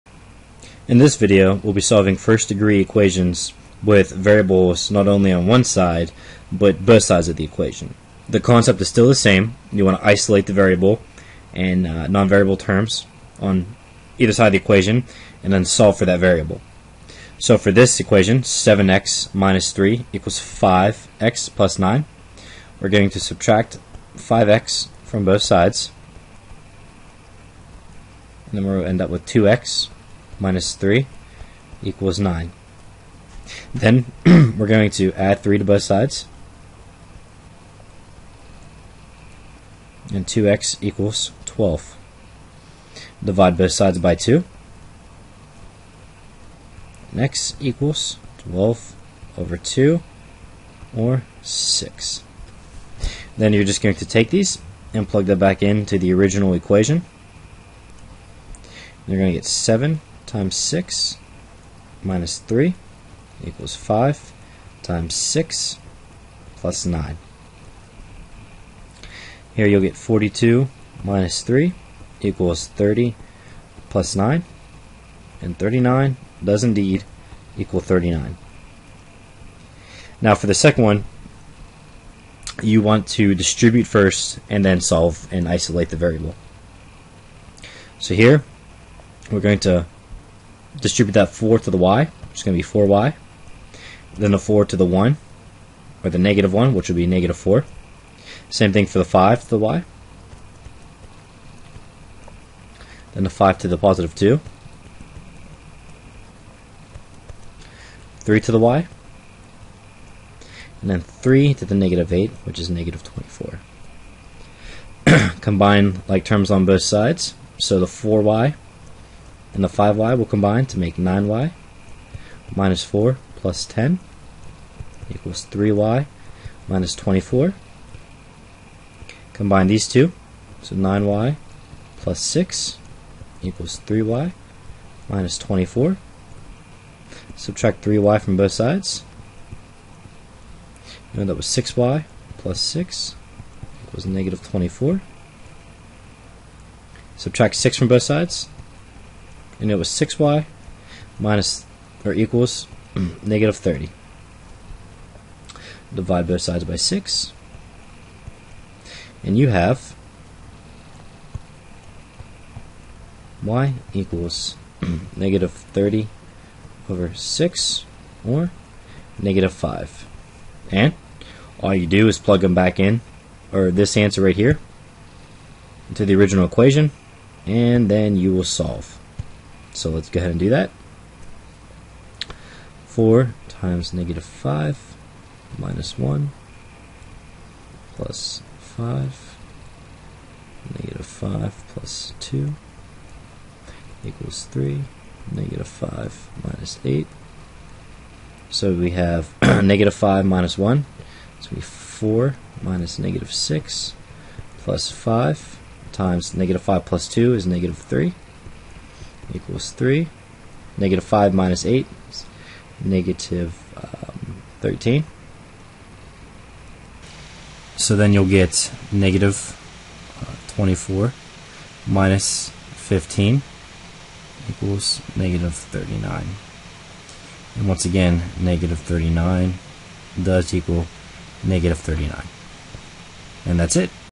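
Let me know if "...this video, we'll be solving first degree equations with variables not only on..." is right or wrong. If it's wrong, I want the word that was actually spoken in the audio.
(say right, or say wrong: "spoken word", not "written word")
right.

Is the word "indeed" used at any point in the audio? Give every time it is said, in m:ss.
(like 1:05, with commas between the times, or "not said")
1:16.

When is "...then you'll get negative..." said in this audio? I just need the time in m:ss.
3:37.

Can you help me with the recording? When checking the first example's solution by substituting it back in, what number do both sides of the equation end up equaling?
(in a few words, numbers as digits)
39.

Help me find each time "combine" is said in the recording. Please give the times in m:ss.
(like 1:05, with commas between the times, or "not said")
1:55, 2:00, 2:09.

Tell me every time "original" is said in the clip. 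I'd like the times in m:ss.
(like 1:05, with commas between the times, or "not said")
0:56, 2:56.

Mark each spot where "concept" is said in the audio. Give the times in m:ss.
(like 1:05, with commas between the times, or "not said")
0:08.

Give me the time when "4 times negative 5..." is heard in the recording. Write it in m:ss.
3:02.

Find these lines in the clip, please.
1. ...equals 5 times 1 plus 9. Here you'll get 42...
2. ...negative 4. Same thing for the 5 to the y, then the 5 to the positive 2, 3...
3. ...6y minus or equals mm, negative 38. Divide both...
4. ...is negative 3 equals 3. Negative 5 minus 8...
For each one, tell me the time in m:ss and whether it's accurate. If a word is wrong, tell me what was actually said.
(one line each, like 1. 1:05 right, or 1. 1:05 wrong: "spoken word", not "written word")
1. 1:03 wrong: "6", not "1"
2. 1:37 right
3. 2:29 wrong: "30", not "38"
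4. 3:27 right.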